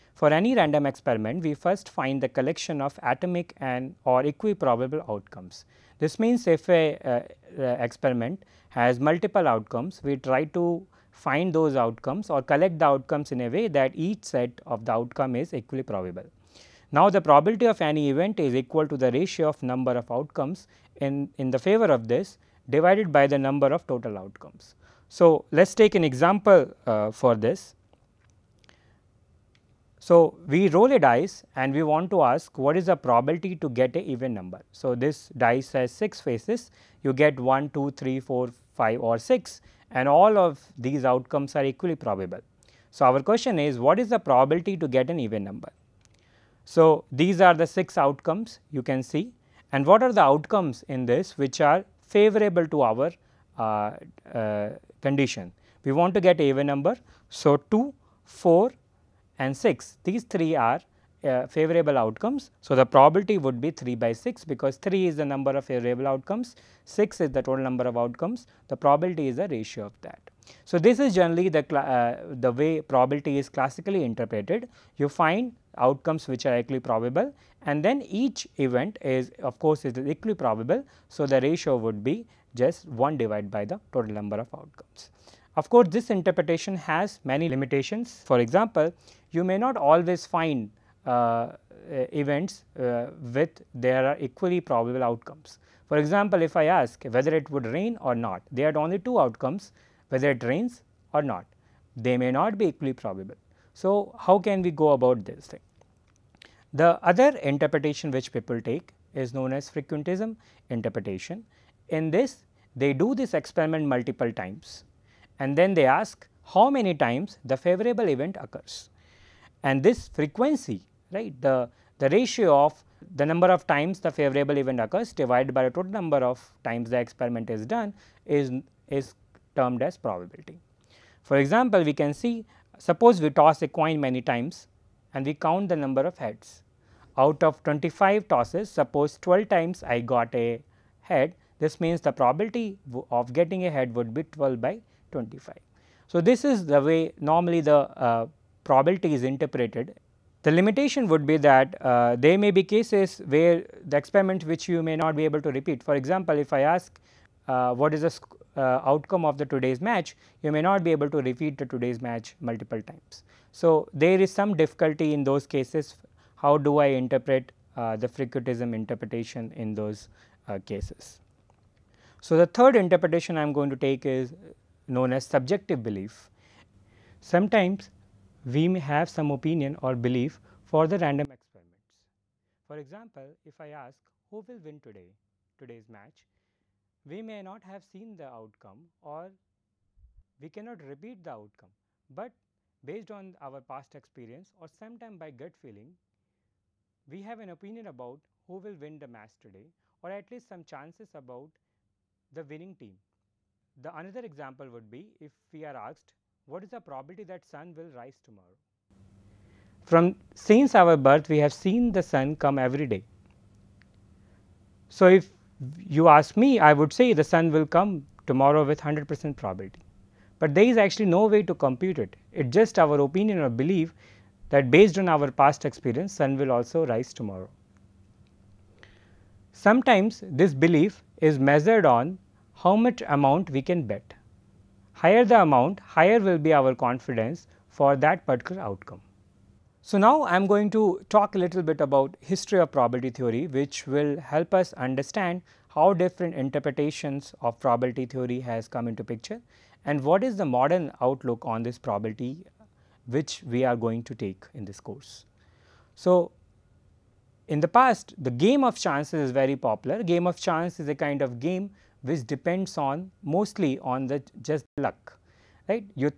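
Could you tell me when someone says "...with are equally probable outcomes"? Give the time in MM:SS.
01:33.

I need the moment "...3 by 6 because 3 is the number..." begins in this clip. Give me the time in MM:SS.
01:03.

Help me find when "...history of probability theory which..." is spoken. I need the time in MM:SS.
04:02.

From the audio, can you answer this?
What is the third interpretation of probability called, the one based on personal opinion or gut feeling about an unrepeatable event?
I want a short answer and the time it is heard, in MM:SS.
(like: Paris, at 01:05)
subjective belief, at 02:55.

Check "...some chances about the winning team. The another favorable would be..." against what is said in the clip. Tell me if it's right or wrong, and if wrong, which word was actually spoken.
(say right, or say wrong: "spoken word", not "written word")
wrong: "example", not "favorable".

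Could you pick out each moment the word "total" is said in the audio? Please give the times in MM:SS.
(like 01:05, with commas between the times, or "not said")
00:23, 01:07, 01:23, 02:05.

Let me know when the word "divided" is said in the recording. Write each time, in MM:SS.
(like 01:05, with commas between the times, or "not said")
00:22, 01:23, 02:05.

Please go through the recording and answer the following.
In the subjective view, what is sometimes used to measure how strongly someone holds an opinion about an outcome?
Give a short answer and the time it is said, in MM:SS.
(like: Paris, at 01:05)
how much amount we can bet, at 03:52.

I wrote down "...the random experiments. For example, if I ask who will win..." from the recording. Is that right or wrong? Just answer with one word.
right.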